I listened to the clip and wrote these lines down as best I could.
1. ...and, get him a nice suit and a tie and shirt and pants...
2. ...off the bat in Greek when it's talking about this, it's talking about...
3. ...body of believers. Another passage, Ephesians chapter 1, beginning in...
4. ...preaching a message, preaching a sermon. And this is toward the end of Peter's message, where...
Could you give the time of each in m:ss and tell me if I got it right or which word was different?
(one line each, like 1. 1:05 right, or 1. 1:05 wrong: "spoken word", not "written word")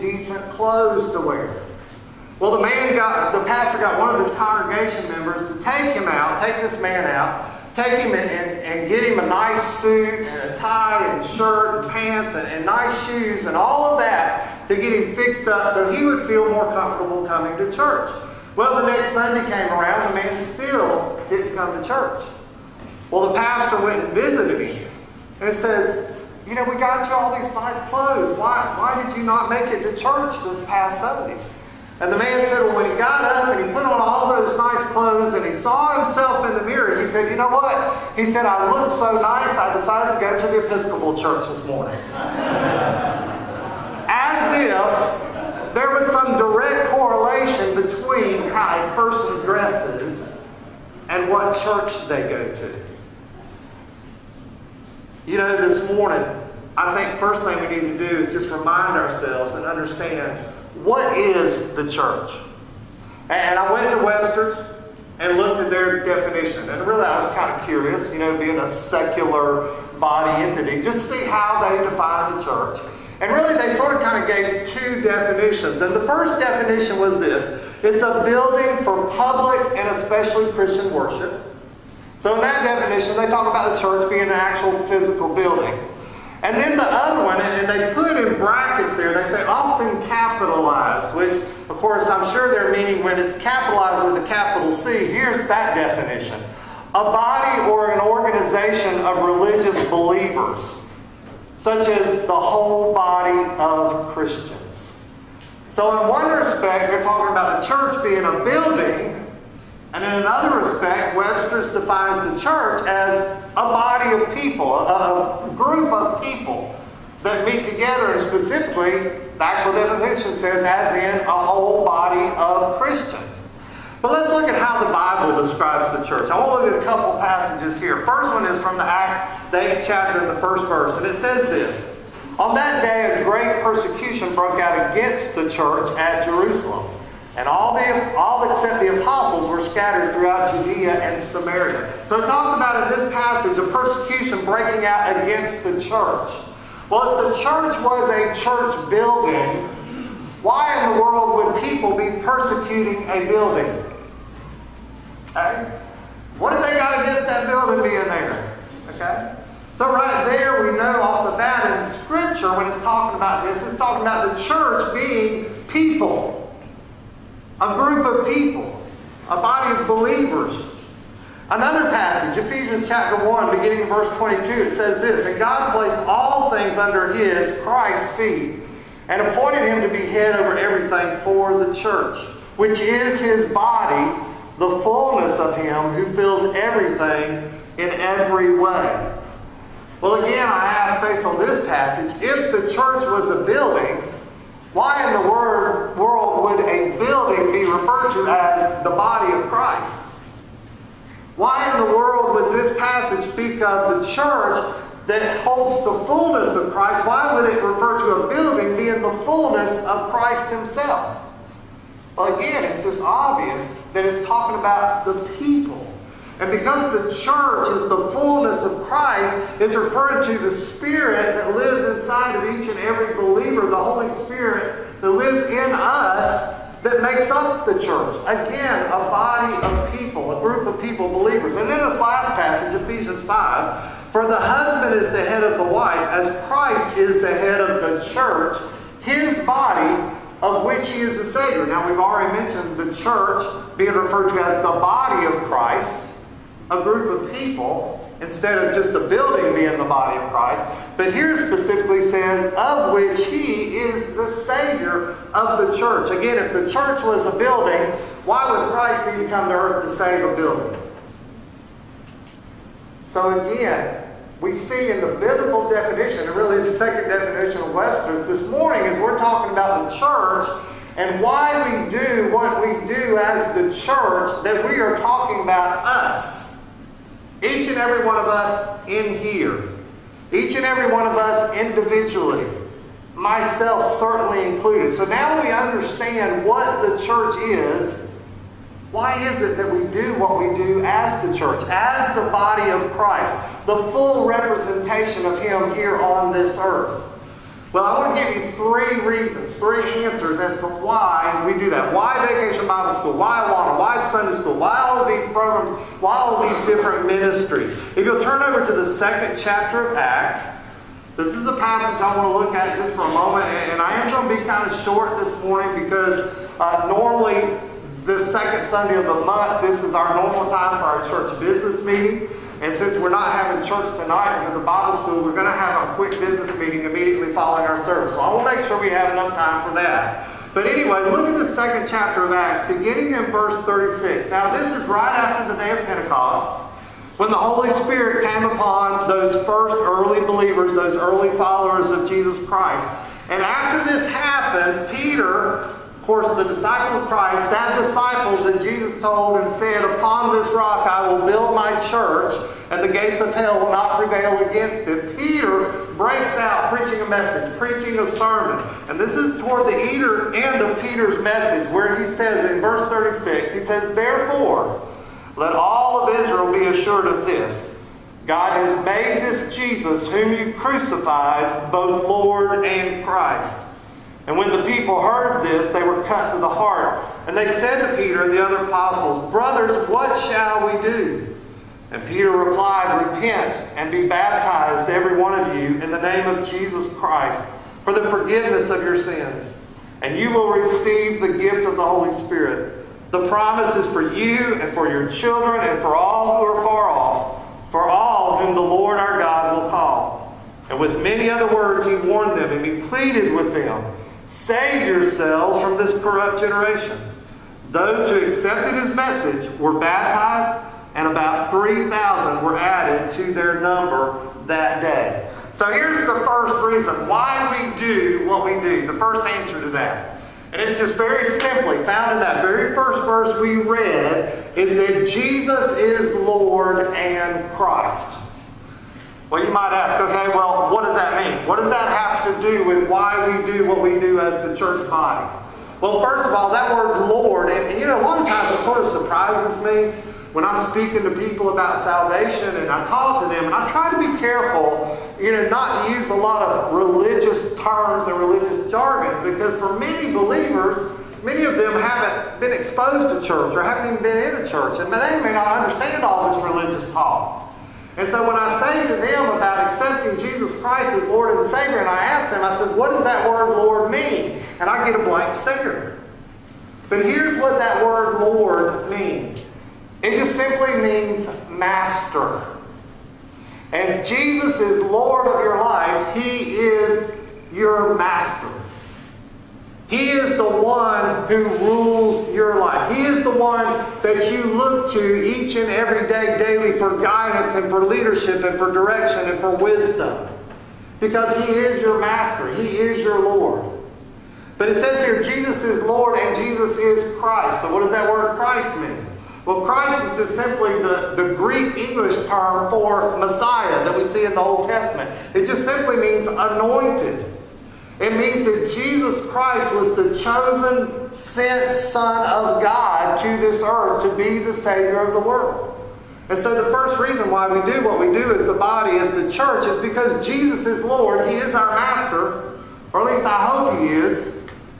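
1. 0:08 right
2. 2:41 wrong: "Scripture", not "Greek"
3. 2:49 right
4. 5:56 right.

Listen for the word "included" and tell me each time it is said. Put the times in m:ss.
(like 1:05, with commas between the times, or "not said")
4:44.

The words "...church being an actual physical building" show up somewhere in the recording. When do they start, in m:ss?
1:23.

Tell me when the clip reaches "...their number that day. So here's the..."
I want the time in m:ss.
6:53.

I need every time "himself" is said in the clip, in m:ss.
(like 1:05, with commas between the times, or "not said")
0:36, 3:30.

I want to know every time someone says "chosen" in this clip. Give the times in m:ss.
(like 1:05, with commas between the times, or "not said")
8:30.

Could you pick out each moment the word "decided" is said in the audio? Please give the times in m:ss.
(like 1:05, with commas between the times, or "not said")
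0:39.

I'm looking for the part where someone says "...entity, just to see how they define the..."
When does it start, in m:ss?
1:10.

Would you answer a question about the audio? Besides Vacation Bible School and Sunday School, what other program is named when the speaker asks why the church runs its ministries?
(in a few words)
AWANA.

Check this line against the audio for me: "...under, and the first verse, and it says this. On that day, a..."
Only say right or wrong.
wrong.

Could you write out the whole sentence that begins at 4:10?
But here specifically says, of which he is the Savior of the church.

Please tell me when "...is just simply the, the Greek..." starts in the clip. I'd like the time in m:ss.
8:20.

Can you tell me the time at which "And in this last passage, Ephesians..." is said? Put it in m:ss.
3:51.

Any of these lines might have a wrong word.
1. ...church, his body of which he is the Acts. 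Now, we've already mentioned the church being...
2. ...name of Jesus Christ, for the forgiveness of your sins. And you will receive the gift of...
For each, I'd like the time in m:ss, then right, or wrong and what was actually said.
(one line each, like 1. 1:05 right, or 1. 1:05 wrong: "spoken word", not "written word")
1. 3:58 wrong: "Savior", not "Acts"
2. 6:26 right.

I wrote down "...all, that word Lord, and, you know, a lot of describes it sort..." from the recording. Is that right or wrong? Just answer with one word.
wrong.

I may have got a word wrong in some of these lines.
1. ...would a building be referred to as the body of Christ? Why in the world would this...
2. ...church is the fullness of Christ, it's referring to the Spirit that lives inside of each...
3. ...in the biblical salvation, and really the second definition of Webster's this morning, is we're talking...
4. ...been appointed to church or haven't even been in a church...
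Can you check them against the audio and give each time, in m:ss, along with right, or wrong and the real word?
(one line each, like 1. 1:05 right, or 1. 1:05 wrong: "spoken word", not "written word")
1. 3:16 right
2. 3:37 right
3. 4:24 wrong: "definition", not "salvation"
4. 7:32 wrong: "exposed", not "appointed".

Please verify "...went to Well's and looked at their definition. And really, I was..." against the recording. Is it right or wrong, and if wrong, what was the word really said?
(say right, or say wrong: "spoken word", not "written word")
wrong: "Webster", not "Well".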